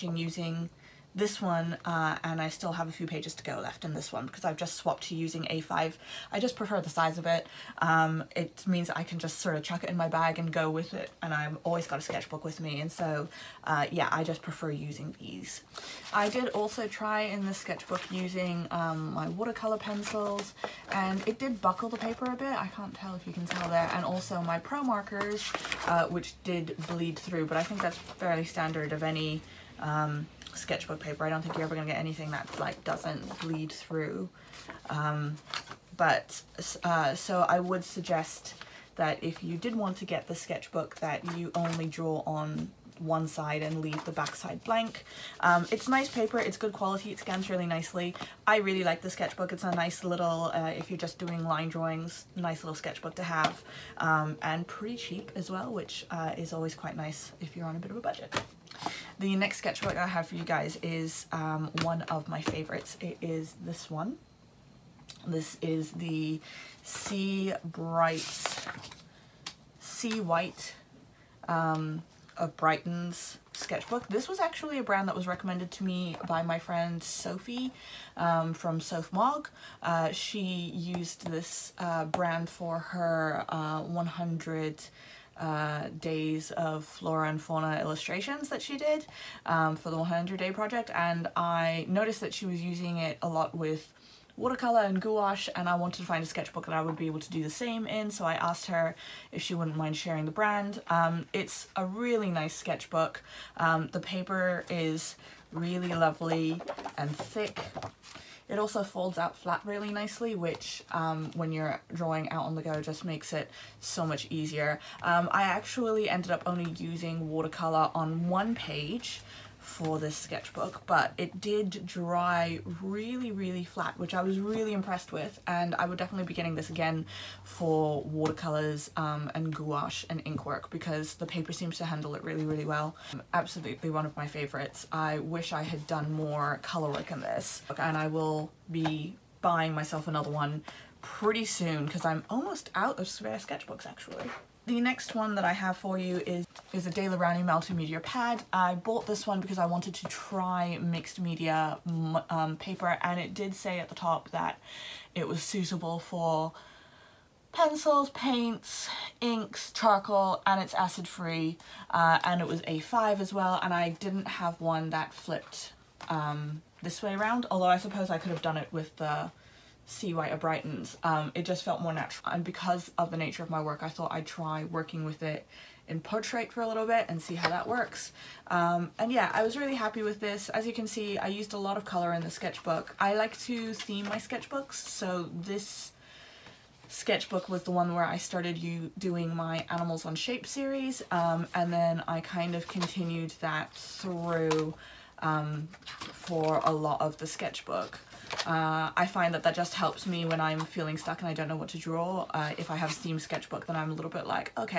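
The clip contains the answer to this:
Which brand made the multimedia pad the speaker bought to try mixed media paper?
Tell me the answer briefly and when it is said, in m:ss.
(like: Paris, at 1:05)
Daler Rowney, at 2:26.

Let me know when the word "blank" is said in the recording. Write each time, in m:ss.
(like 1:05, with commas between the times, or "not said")
0:44.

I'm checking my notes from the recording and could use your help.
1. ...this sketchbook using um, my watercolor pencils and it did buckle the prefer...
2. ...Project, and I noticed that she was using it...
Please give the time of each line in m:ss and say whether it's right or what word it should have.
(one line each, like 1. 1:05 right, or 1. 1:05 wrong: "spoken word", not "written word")
1. 0:17 wrong: "paper", not "prefer"
2. 1:30 right.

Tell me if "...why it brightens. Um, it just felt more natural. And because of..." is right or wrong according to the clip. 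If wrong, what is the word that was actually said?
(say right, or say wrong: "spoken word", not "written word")
right.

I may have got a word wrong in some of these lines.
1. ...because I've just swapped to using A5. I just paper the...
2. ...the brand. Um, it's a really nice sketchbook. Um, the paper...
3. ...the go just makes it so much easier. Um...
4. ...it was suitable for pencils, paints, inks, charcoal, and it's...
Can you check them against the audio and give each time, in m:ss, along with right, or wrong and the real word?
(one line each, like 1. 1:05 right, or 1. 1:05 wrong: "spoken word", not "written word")
1. 0:04 wrong: "prefer", not "paper"
2. 1:40 right
3. 1:52 right
4. 2:35 right.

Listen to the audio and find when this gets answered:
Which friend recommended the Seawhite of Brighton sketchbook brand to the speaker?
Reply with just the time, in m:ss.
1:17.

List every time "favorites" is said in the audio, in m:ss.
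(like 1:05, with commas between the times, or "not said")
1:02, 2:14.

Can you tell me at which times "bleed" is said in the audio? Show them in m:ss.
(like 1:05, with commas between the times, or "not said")
0:26, 0:33.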